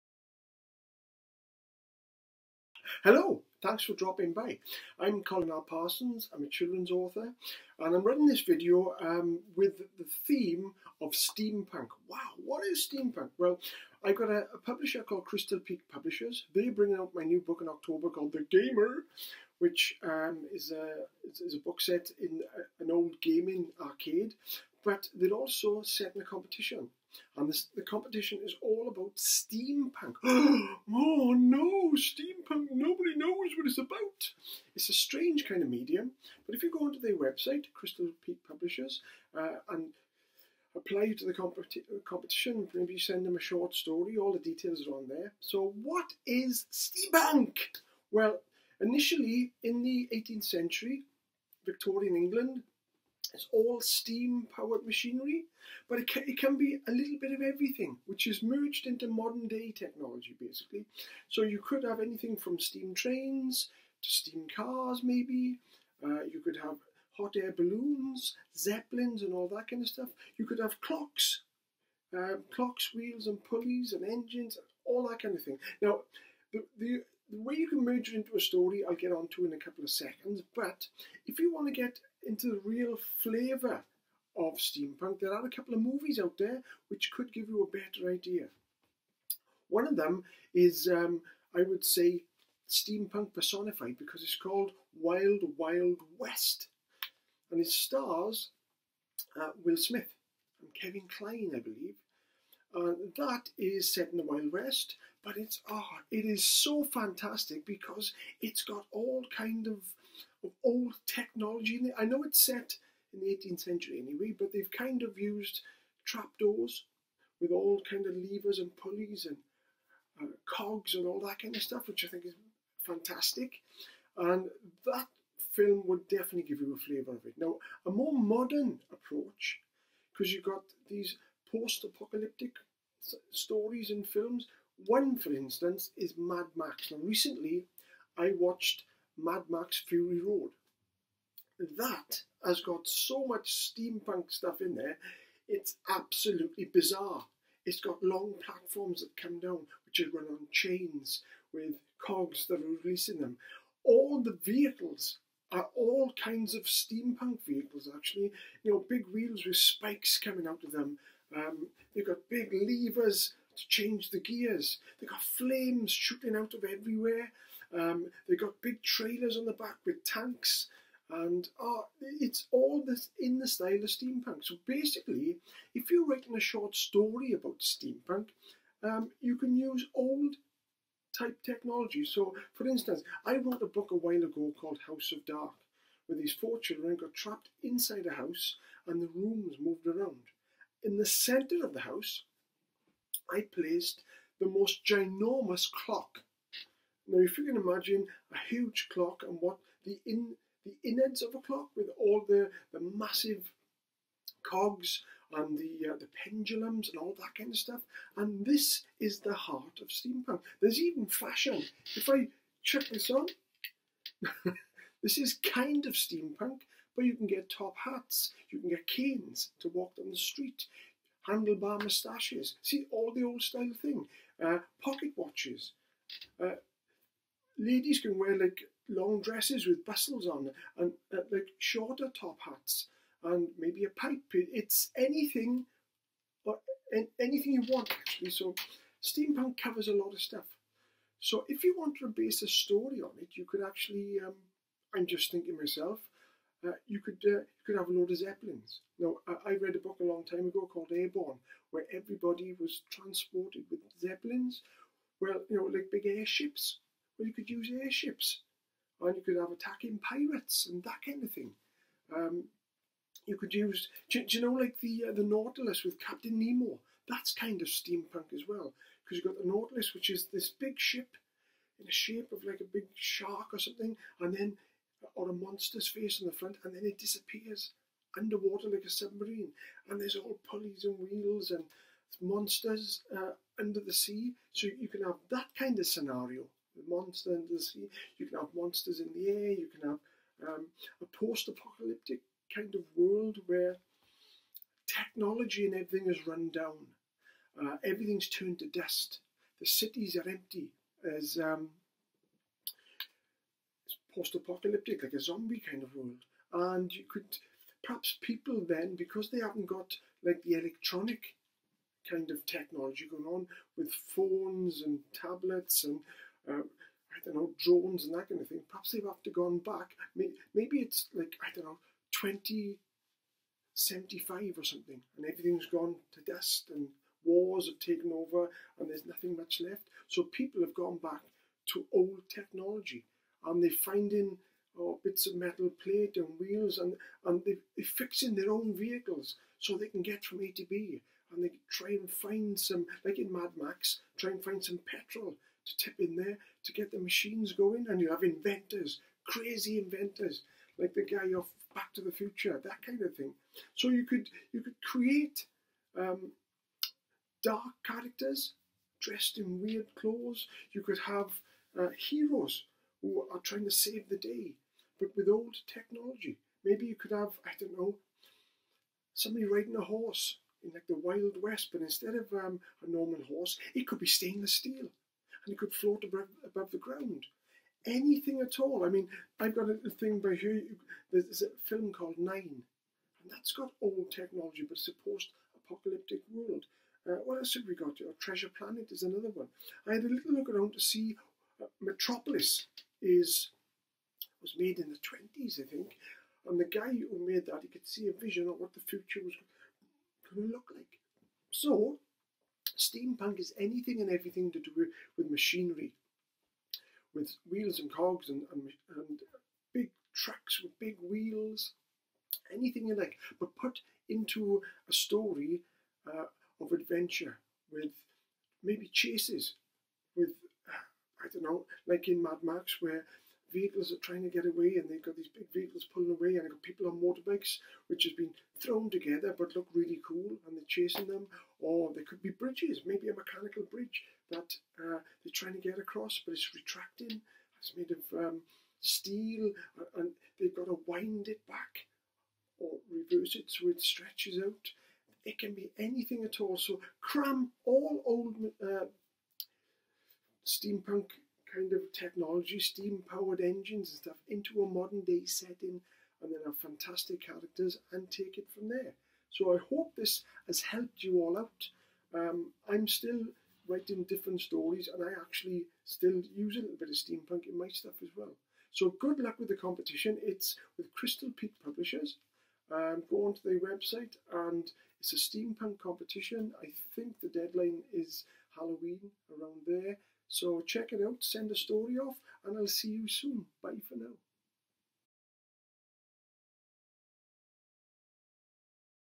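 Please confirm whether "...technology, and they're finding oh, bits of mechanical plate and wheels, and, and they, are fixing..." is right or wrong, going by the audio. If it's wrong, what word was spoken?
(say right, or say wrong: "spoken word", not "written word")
wrong: "metal", not "mechanical".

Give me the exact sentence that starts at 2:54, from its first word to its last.
So basically, if you're writing a short story about steampunk, um, you can use old type technology.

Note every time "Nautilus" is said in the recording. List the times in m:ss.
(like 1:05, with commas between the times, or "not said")
4:25, 4:29.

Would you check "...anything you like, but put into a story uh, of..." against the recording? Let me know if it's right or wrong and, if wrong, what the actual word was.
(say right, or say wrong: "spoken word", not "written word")
right.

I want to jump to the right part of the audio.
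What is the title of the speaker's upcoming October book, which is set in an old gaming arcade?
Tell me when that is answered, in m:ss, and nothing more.
0:18.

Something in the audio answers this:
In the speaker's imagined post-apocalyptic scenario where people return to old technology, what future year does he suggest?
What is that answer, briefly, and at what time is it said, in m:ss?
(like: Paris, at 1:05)
2075, at 5:22.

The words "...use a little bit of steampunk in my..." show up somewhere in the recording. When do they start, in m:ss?
7:46.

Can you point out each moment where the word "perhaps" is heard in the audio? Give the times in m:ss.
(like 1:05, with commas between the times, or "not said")
5:07, 5:18.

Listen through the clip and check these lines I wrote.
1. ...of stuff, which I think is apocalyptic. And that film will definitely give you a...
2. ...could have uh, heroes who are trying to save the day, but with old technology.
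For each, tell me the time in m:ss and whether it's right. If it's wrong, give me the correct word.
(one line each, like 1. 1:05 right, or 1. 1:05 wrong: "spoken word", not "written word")
1. 2:01 wrong: "fantastic", not "apocalyptic"
2. 6:00 right.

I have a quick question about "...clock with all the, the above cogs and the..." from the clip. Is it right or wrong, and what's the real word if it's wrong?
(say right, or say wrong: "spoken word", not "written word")
wrong: "massive", not "above".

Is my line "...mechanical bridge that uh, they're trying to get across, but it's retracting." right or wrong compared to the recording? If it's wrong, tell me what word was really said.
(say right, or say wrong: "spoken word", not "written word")
right.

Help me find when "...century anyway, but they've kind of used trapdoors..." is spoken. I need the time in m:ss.
1:53.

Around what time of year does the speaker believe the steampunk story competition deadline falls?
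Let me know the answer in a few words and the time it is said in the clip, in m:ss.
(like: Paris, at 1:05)
Halloween, at 7:58.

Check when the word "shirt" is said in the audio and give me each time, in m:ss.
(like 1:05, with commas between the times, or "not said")
not said.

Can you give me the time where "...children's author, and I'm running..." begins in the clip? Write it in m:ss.
0:06.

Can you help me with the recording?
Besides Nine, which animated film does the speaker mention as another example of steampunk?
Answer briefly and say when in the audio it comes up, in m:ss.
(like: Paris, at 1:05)
Treasure Planet, at 6:28.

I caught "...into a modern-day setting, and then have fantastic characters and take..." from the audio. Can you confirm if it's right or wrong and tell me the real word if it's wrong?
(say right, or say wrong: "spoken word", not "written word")
right.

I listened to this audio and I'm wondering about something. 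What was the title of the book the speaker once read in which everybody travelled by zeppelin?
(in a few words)
Airborne.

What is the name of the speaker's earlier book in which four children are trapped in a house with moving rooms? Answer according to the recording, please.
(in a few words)
House of Dark.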